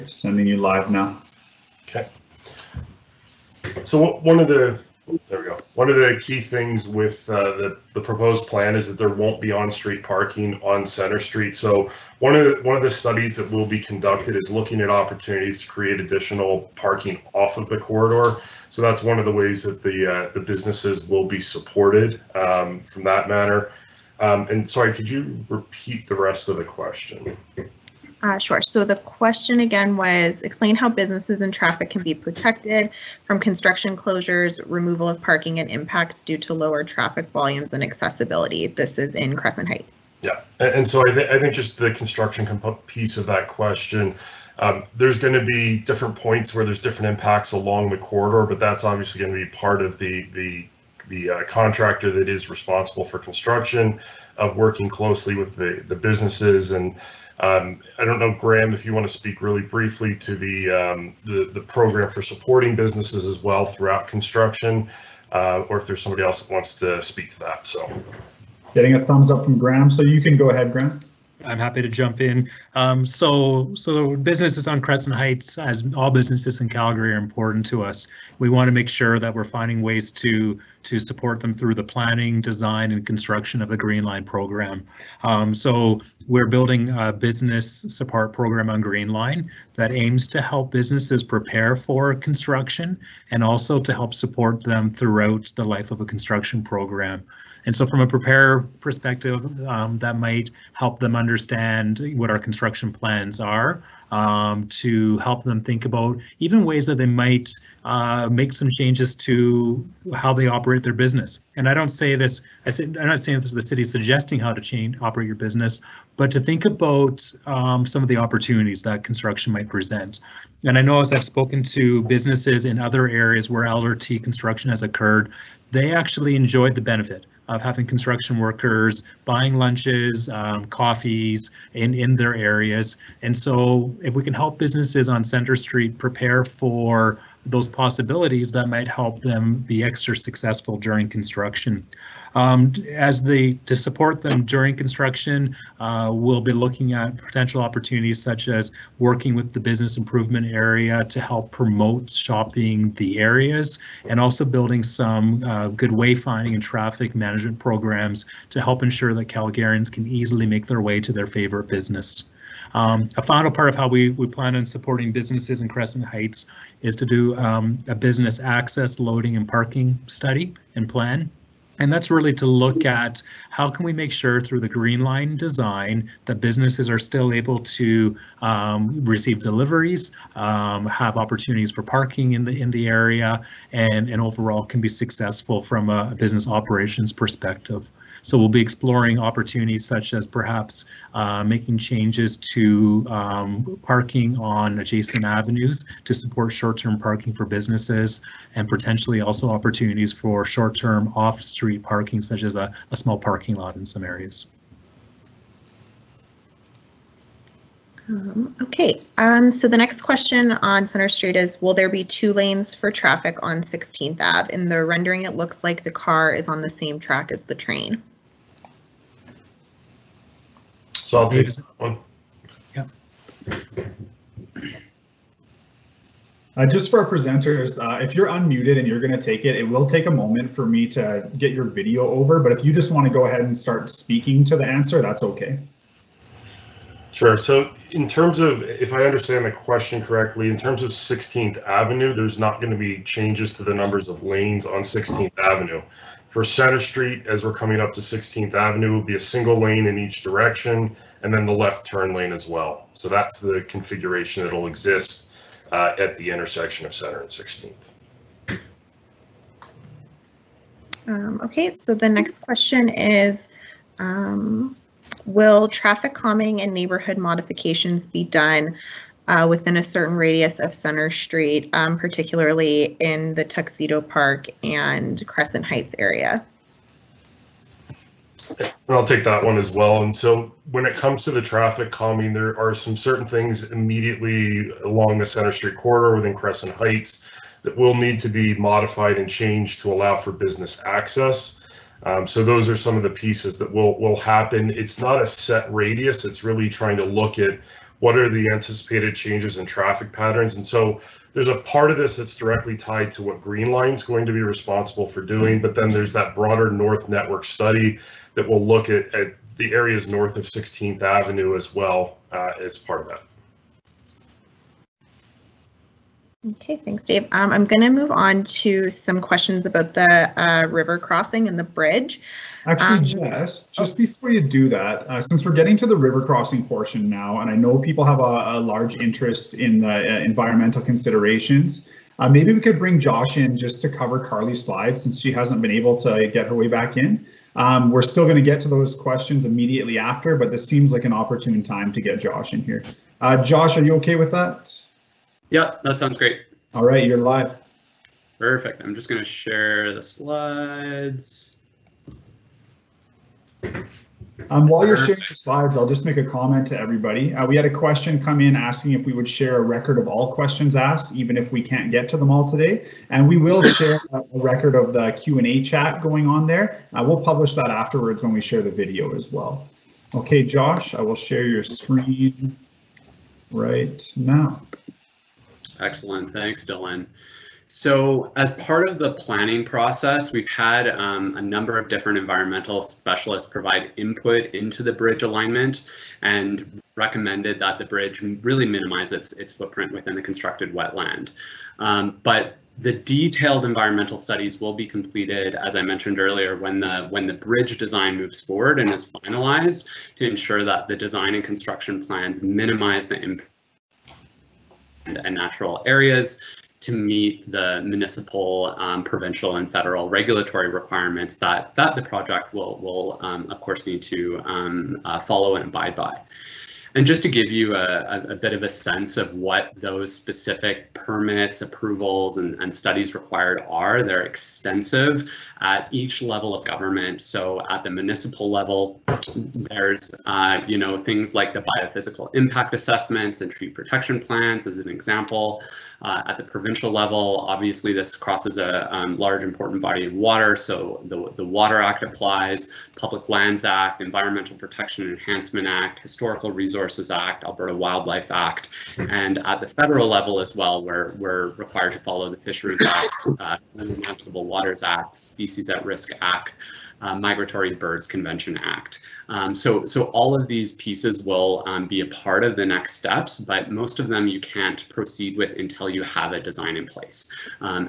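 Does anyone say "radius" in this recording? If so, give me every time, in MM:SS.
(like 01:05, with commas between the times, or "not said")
04:30, 04:55.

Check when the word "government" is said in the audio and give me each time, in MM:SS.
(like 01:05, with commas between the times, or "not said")
07:06.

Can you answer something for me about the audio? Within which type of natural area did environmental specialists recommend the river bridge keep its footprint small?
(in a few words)
Constructed wetland.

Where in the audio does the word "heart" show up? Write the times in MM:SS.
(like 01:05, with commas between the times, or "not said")
not said.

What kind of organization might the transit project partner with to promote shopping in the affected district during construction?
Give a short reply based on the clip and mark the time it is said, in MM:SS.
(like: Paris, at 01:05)
Business improvement area, at 02:29.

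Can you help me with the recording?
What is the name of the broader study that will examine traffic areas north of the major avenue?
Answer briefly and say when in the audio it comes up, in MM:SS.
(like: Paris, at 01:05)
North Network study, at 05:06.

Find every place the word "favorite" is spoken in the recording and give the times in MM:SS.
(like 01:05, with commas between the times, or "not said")
02:41.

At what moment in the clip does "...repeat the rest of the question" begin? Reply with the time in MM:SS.
00:25.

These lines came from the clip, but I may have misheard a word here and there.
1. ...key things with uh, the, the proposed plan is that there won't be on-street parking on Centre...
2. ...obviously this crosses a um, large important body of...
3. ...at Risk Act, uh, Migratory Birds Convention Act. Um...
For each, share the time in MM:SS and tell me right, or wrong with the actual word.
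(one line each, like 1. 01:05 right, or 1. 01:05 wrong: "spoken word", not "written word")
1. 00:06 right
2. 07:17 right
3. 07:35 right.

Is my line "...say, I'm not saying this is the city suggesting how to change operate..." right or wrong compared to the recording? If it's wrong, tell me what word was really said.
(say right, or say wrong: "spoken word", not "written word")
right.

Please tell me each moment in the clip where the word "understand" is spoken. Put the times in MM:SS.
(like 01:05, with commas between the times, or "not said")
01:41, 03:59.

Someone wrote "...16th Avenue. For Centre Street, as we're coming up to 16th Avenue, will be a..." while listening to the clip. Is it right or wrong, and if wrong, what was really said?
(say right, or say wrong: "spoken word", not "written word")
right.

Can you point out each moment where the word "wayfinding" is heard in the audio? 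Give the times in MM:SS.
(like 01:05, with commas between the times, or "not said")
02:35.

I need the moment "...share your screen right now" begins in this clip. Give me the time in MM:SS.
06:11.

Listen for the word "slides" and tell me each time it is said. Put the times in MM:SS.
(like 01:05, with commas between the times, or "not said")
05:34, 05:50, 05:55.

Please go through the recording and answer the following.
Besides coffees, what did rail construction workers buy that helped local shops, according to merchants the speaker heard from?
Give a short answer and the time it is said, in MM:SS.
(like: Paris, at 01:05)
Lunches, at 02:09.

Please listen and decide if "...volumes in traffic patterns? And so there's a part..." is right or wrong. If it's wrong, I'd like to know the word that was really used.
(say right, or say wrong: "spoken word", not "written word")
wrong: "changes", not "volumes".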